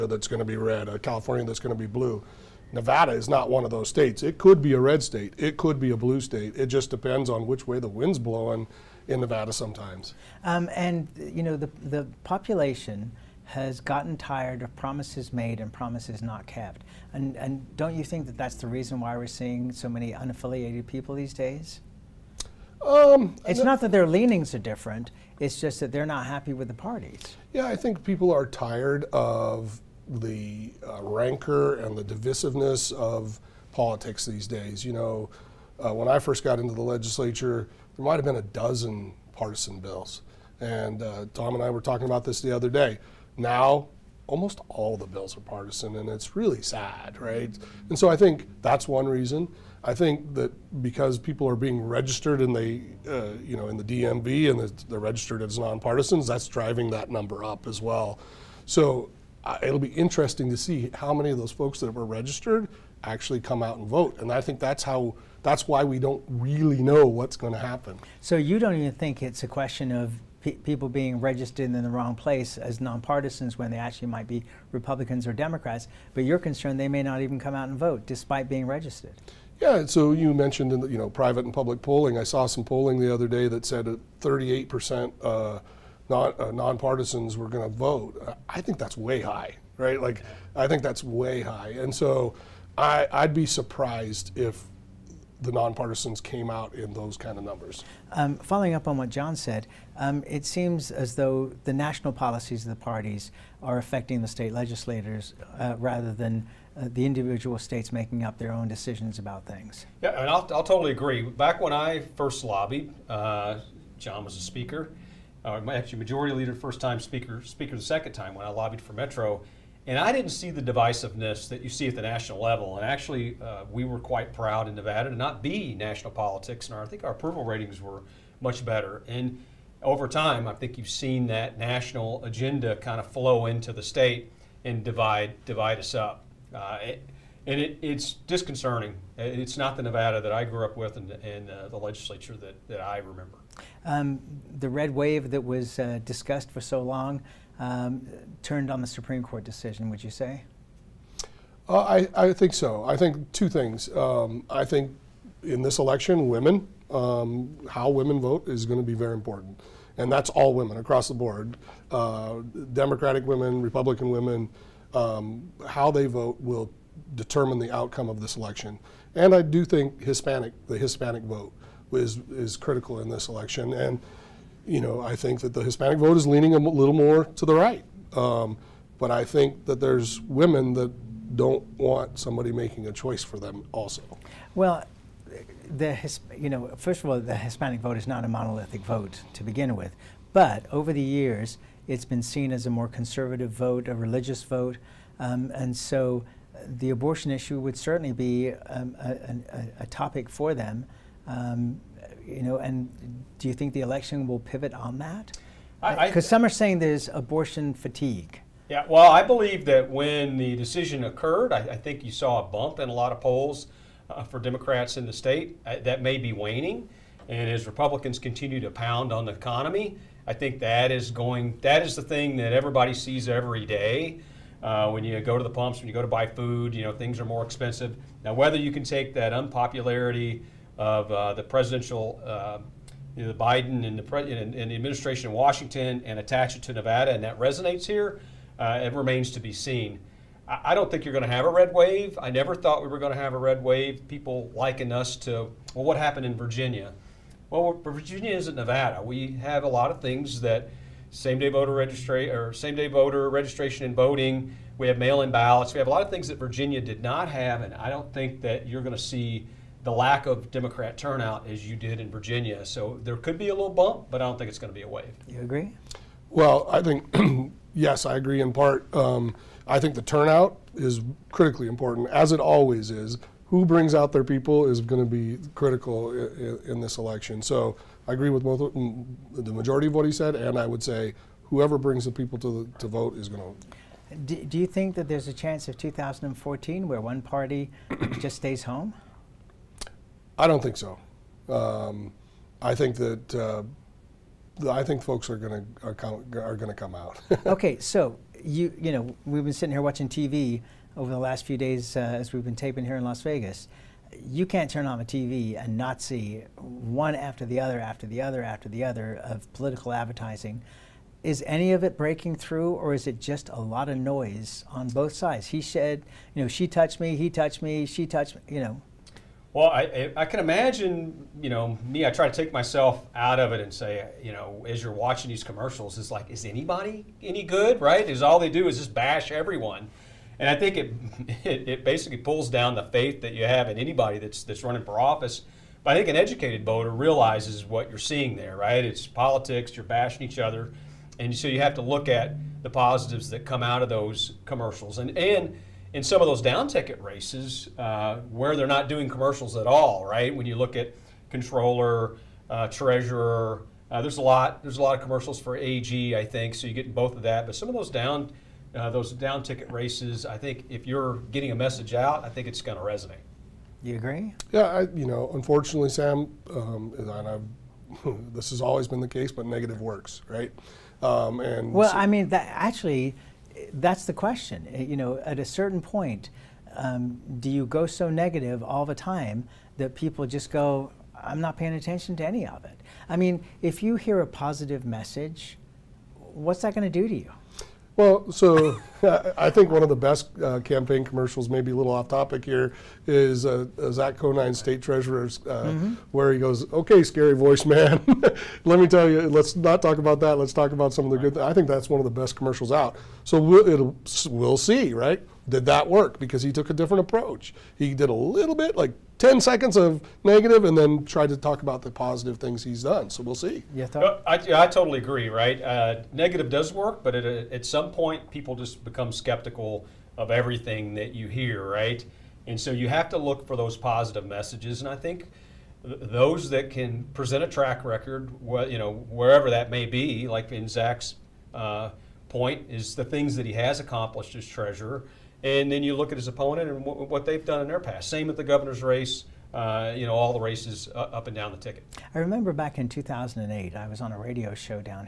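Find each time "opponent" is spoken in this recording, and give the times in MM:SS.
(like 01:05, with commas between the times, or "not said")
07:16.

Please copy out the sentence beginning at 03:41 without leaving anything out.
That is the thing that everybody sees every day.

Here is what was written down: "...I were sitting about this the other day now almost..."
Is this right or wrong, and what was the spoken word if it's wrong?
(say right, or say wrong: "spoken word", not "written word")
wrong: "talking", not "sitting".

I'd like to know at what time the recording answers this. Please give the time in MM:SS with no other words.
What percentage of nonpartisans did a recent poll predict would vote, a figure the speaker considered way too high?
01:24.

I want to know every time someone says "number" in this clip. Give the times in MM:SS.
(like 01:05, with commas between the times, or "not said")
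00:57, 01:37.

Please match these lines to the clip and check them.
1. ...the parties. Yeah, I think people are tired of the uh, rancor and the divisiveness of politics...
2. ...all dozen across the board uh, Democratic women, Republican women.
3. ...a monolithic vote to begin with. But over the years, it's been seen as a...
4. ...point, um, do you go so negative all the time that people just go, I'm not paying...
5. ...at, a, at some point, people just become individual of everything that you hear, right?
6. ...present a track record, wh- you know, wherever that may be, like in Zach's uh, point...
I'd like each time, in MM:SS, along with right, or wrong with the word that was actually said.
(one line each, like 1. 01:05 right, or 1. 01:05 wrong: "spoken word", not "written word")
1. 00:26 right
2. 02:40 wrong: "women", not "dozen"
3. 03:08 right
4. 06:15 right
5. 06:57 wrong: "skeptical", not "individual"
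6. 07:07 right.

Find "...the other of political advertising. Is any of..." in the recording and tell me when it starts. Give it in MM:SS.
05:08.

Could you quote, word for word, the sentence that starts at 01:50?
Yeah, and I'll, I'll totally agree.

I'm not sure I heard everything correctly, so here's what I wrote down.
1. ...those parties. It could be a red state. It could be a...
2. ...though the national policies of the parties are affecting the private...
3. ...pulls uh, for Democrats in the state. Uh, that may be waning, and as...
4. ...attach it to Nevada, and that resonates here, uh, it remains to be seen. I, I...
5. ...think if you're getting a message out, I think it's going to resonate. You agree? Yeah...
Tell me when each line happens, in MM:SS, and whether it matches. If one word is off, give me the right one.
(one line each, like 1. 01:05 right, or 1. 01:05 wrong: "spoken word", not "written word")
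1. 00:03 wrong: "states", not "parties"
2. 01:41 wrong: "state", not "private"
3. 03:33 wrong: "polls", not "pulls"
4. 03:56 right
5. 06:00 right.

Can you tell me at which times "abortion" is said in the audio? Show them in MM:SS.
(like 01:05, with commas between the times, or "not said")
03:16, 03:27.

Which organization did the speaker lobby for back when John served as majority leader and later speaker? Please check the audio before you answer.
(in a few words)
Metro.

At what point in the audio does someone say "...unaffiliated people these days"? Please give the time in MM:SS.
00:20.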